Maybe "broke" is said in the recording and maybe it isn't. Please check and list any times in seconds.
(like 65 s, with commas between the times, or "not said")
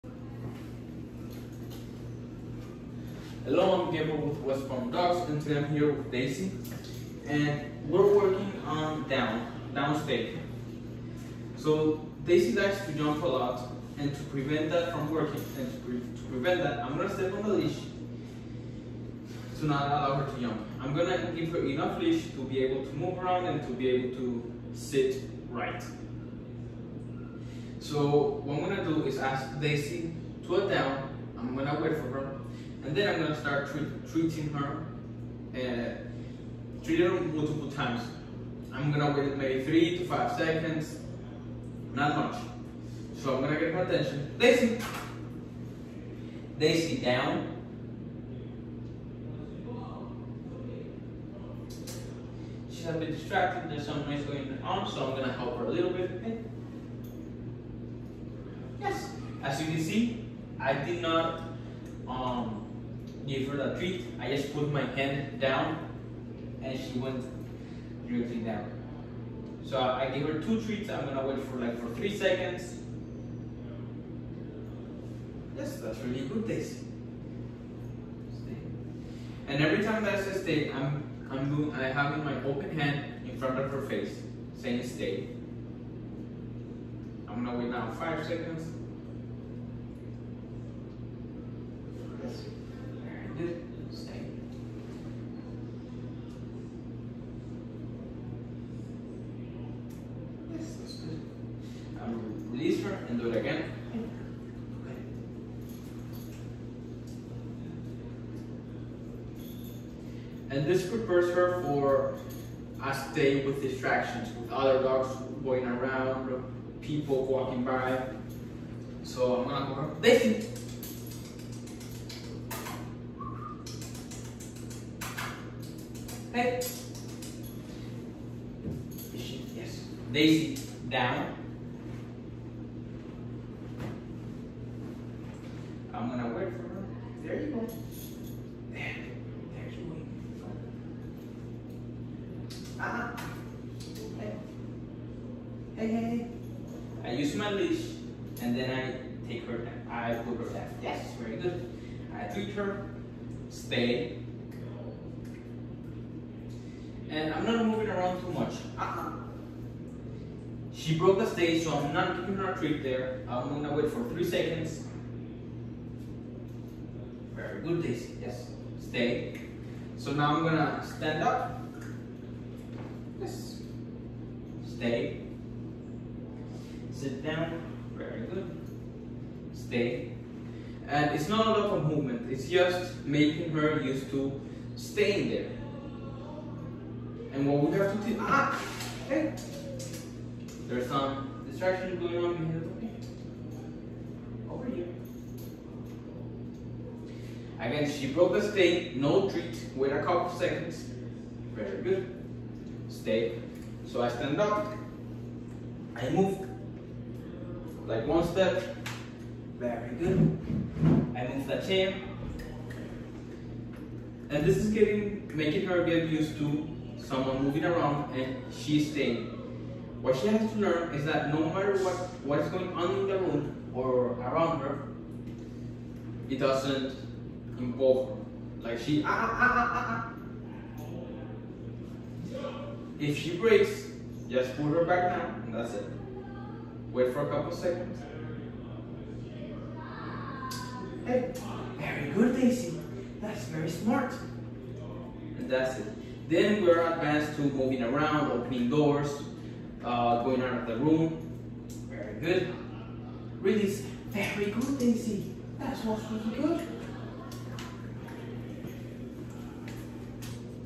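160 s, 198 s.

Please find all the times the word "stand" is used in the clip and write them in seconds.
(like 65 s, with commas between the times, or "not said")
170 s, 204 s.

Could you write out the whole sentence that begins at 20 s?
I'm gonna give her enough leash to be able to move around and to be able to sit right.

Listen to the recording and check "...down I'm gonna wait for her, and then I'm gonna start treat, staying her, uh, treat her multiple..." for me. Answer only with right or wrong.
wrong.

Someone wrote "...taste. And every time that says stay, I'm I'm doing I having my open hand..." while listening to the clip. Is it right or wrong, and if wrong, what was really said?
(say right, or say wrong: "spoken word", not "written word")
right.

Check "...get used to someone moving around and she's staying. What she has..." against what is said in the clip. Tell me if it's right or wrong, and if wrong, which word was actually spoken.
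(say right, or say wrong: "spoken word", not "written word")
right.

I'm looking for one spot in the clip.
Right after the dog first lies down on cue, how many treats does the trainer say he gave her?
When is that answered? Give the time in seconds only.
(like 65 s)
70 s.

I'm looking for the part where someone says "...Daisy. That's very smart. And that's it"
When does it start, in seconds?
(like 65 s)
242 s.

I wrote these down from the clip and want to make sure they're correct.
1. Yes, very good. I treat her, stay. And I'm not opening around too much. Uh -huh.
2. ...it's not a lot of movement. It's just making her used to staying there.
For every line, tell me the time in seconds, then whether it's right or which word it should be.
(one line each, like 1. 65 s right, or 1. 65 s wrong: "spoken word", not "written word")
1. 150 s wrong: "moving", not "opening"
2. 181 s right.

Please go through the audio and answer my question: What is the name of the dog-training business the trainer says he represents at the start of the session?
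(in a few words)
West Palm Dogs.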